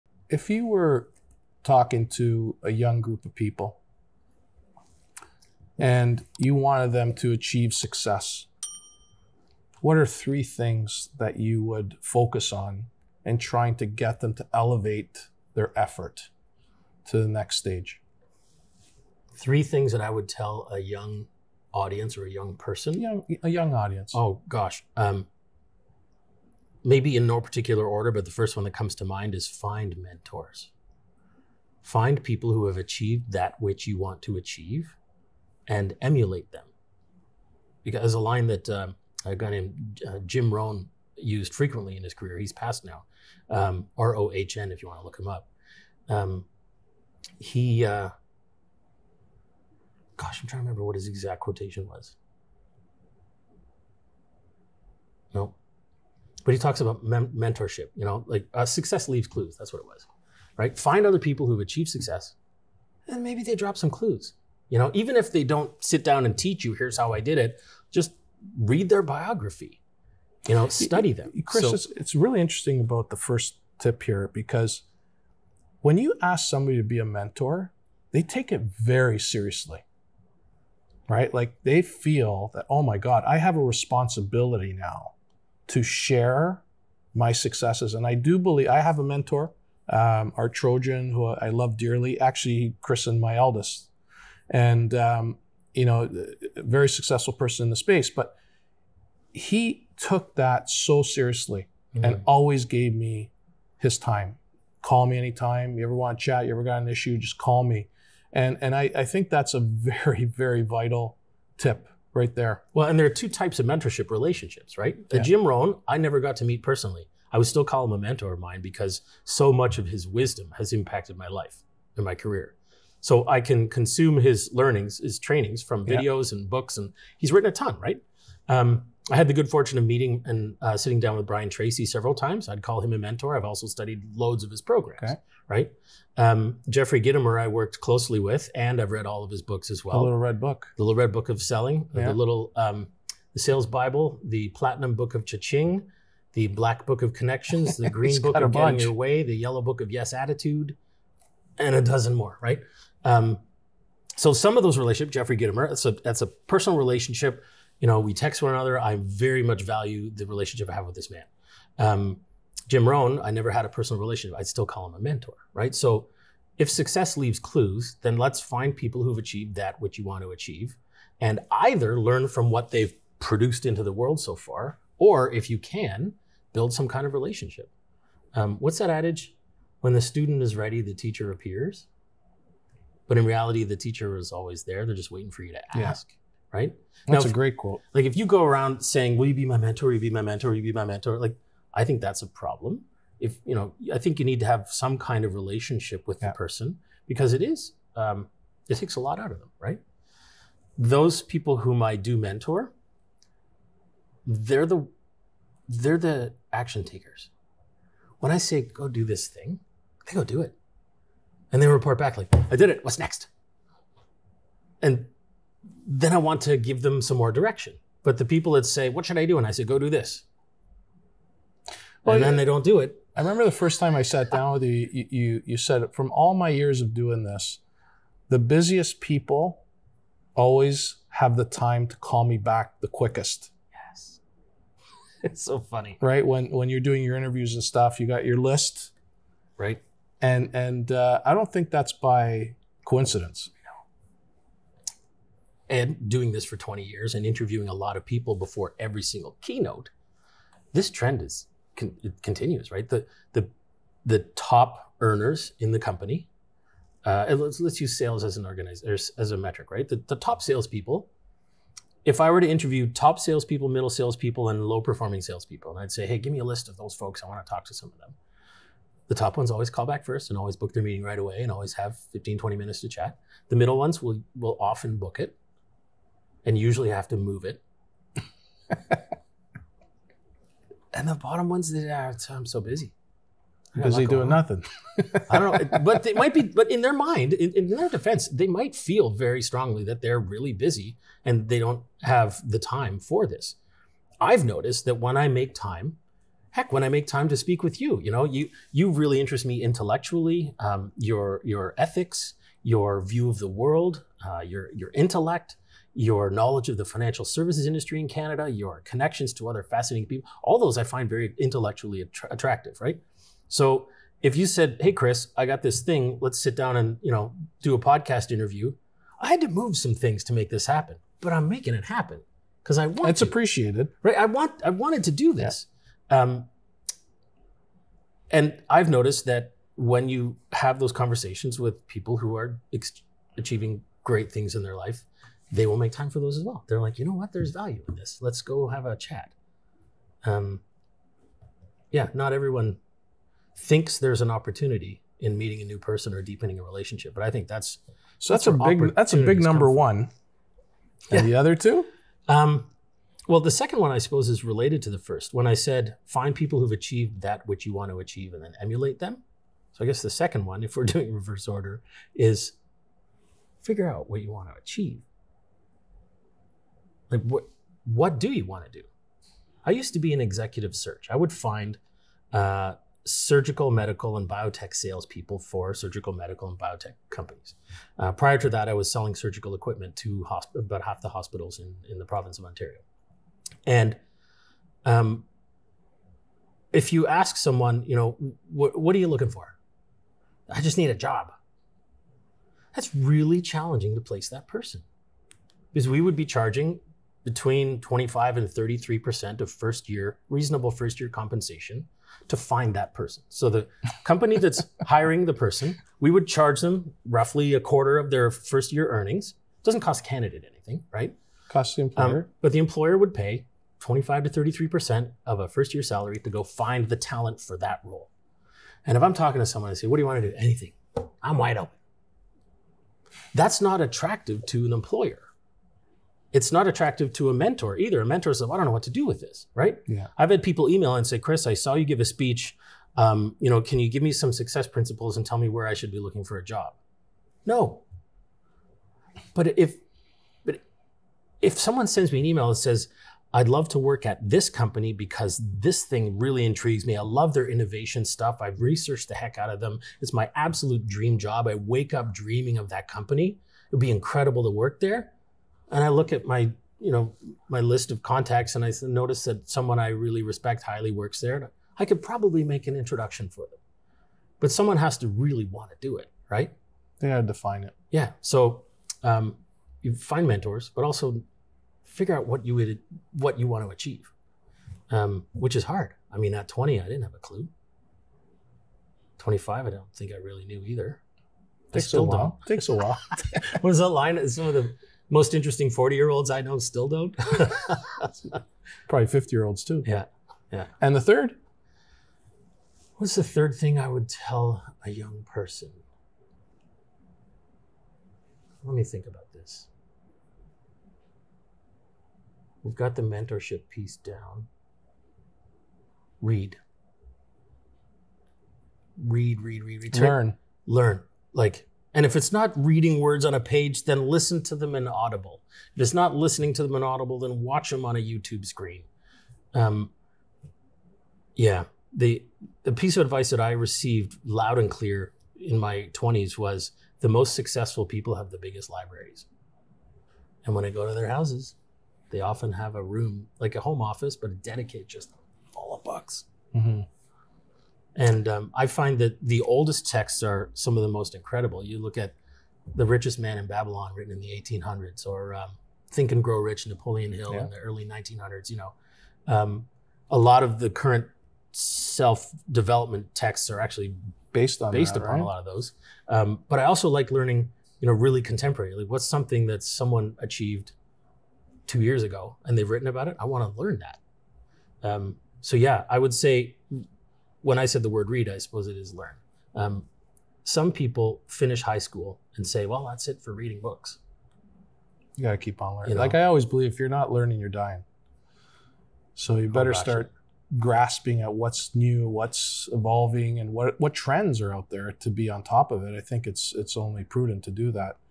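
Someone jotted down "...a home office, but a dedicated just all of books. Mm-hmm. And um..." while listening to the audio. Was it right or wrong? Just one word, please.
right.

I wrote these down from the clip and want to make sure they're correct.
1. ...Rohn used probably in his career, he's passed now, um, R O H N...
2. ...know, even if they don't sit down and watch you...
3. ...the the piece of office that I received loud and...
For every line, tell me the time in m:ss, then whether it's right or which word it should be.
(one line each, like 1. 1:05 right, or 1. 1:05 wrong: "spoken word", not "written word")
1. 0:40 wrong: "frequently", not "probably"
2. 1:04 wrong: "teach", not "watch"
3. 8:41 wrong: "advice", not "office".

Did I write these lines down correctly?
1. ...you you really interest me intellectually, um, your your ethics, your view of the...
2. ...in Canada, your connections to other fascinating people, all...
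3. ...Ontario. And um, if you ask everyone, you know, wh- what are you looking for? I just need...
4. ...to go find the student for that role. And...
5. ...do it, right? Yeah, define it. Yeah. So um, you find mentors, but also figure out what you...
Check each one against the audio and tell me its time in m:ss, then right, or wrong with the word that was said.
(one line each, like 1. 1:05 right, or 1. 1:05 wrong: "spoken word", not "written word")
1. 4:58 right
2. 5:07 right
3. 6:22 wrong: "someone", not "everyone"
4. 6:56 wrong: "talent", not "student"
5. 7:45 right.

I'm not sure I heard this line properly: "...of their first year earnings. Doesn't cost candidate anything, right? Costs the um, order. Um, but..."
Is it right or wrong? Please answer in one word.
wrong.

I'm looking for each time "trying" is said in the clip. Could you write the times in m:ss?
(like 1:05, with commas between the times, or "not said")
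0:13, 0:50.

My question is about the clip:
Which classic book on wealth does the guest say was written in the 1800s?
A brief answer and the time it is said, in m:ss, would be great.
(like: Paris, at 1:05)
The Richest Man in Babylon, at 9:02.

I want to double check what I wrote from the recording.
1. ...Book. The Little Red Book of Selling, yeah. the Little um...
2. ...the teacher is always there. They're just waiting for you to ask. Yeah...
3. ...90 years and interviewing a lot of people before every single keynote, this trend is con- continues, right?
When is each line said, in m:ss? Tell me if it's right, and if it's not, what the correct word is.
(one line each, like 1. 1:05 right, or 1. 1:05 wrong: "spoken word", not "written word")
1. 2:20 right
2. 3:03 right
3. 4:06 wrong: "20", not "90".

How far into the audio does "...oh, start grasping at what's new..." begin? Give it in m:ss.
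9:39.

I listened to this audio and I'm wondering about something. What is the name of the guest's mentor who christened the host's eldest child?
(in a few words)
our Trojan.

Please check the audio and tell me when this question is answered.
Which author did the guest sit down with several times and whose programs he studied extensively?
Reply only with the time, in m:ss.
2:11.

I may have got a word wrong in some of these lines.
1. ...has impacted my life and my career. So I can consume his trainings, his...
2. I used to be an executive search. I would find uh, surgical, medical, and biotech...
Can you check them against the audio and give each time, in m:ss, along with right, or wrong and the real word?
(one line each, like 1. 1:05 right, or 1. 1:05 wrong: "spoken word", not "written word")
1. 2:00 wrong: "learnings", not "trainings"
2. 6:09 right.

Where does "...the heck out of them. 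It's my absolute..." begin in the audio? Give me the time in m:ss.
7:29.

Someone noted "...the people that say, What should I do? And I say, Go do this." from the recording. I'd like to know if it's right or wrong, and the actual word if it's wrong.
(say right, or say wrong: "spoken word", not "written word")
right.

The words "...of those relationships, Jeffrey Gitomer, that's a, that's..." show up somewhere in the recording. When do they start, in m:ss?
2:34.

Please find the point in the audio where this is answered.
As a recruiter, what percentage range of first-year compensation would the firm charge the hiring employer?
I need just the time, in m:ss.
6:37.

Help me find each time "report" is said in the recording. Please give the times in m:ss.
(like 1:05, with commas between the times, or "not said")
3:31.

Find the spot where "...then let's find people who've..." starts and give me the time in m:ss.
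2:48.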